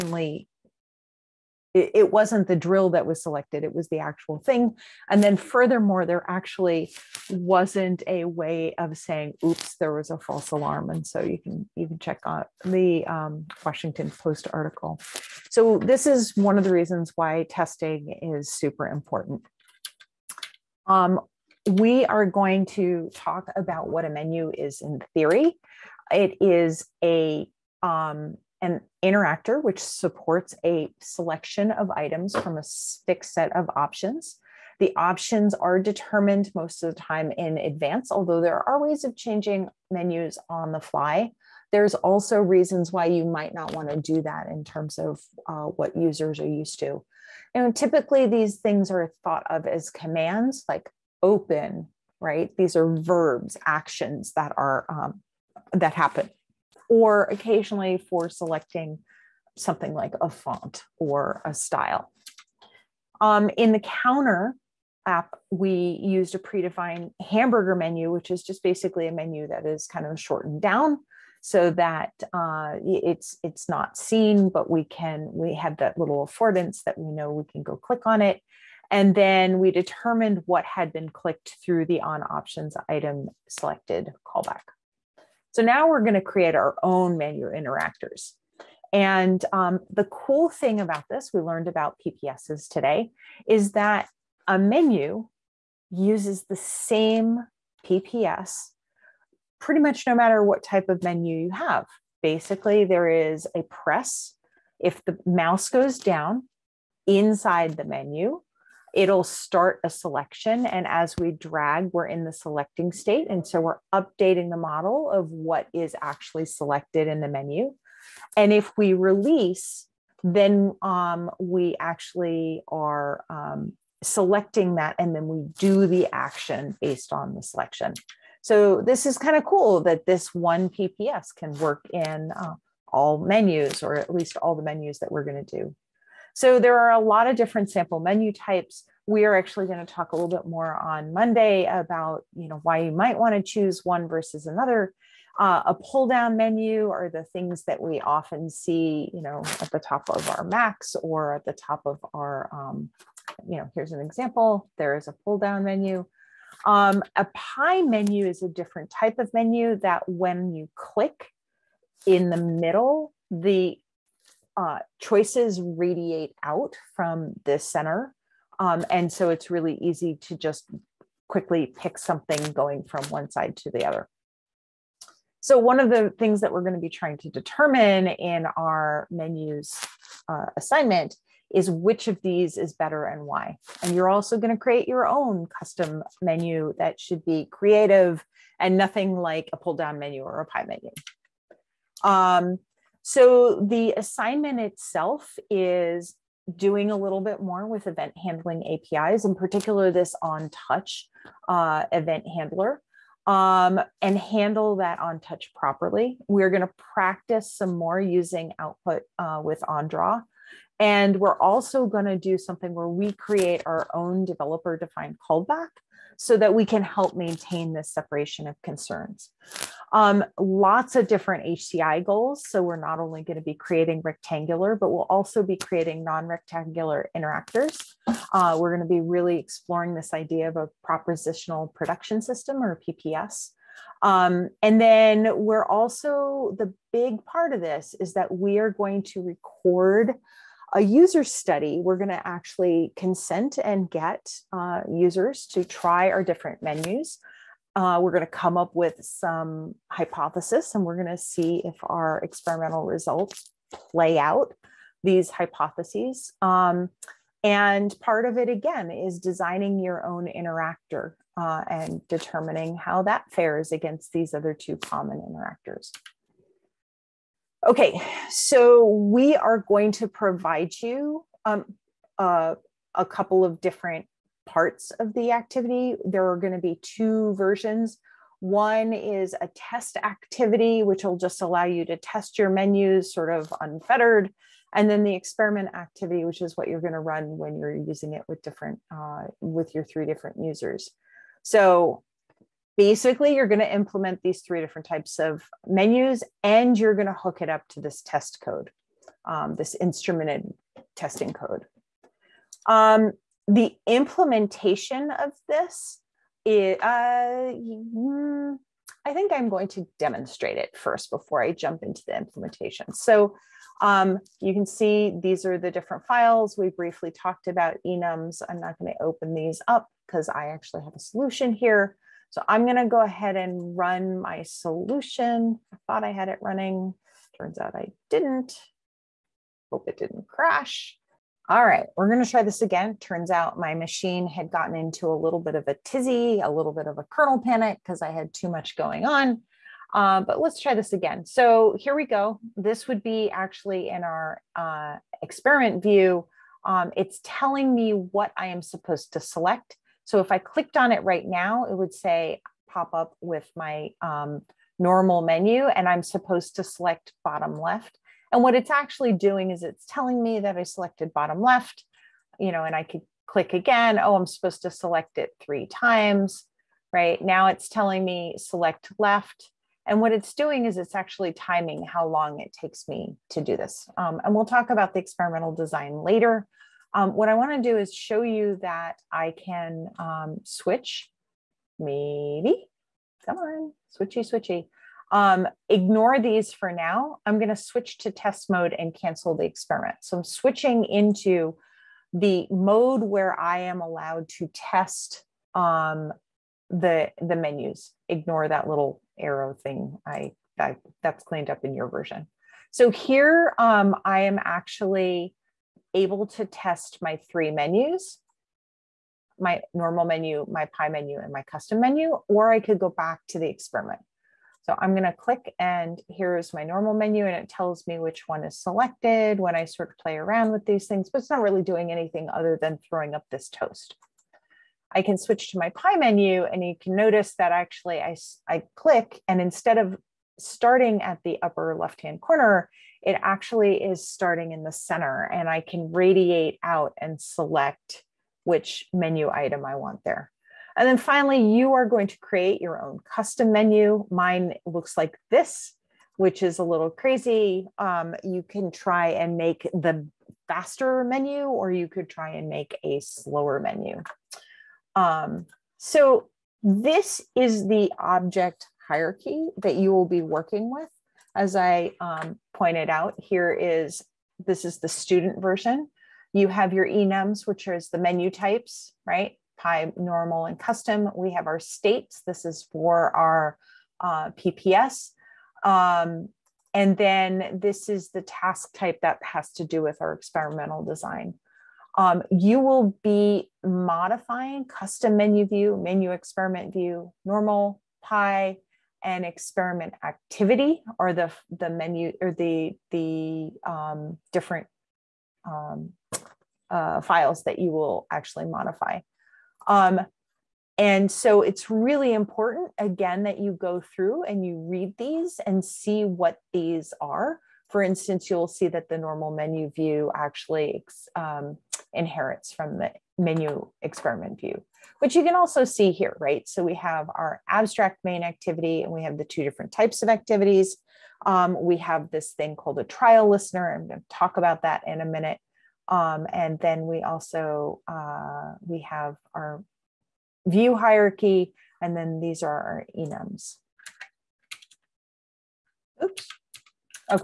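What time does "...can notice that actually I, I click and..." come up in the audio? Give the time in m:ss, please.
7:06.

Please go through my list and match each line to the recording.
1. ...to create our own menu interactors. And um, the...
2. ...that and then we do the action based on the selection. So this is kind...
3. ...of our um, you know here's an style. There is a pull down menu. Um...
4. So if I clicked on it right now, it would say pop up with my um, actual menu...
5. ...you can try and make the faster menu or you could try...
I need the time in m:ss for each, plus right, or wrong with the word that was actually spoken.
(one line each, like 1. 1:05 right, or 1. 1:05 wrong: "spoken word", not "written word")
1. 1:26 right
2. 2:04 right
3. 2:31 wrong: "example", not "style"
4. 5:50 wrong: "normal", not "actual"
5. 7:28 right.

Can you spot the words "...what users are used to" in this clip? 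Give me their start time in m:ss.
0:45.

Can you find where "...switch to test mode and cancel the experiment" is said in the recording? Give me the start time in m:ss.
6:27.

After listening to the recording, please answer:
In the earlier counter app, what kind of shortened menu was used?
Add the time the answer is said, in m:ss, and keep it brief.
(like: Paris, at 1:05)
hamburger menu, at 1:07.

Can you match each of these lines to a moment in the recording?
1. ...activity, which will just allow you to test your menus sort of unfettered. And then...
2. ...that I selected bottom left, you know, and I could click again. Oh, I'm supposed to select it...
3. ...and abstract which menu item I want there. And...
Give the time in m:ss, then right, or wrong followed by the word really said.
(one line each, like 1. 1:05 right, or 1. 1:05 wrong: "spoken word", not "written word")
1. 4:39 right
2. 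6:00 right
3. 7:16 wrong: "select", not "abstract".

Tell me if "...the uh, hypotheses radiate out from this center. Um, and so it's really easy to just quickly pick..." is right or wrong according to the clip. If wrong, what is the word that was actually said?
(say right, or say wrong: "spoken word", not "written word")
wrong: "choices", not "hypotheses".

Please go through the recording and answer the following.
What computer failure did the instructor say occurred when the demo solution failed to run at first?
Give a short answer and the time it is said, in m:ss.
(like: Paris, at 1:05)
kernel panic, at 5:37.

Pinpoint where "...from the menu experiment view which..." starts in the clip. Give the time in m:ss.
8:32.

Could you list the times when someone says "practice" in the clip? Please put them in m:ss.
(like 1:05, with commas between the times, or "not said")
3:26.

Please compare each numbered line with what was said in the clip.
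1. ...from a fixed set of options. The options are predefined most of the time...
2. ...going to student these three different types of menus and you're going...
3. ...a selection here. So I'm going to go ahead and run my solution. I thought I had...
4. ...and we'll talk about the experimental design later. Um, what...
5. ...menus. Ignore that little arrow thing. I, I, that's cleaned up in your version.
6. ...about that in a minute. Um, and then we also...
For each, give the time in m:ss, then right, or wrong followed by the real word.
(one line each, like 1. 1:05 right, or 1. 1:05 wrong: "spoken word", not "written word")
1. 0:32 wrong: "determined", not "predefined"
2. 4:53 wrong: "implement", not "student"
3. 5:20 wrong: "solution", not "selection"
4. 6:14 right
5. 6:37 right
6. 8:44 right.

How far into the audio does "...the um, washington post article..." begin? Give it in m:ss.
0:12.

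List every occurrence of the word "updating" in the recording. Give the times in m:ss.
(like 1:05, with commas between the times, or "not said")
1:53.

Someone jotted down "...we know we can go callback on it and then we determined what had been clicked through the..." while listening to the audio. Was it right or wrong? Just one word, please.
wrong.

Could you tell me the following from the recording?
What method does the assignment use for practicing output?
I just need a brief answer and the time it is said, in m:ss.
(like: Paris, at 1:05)
OnDraw, at 3:29.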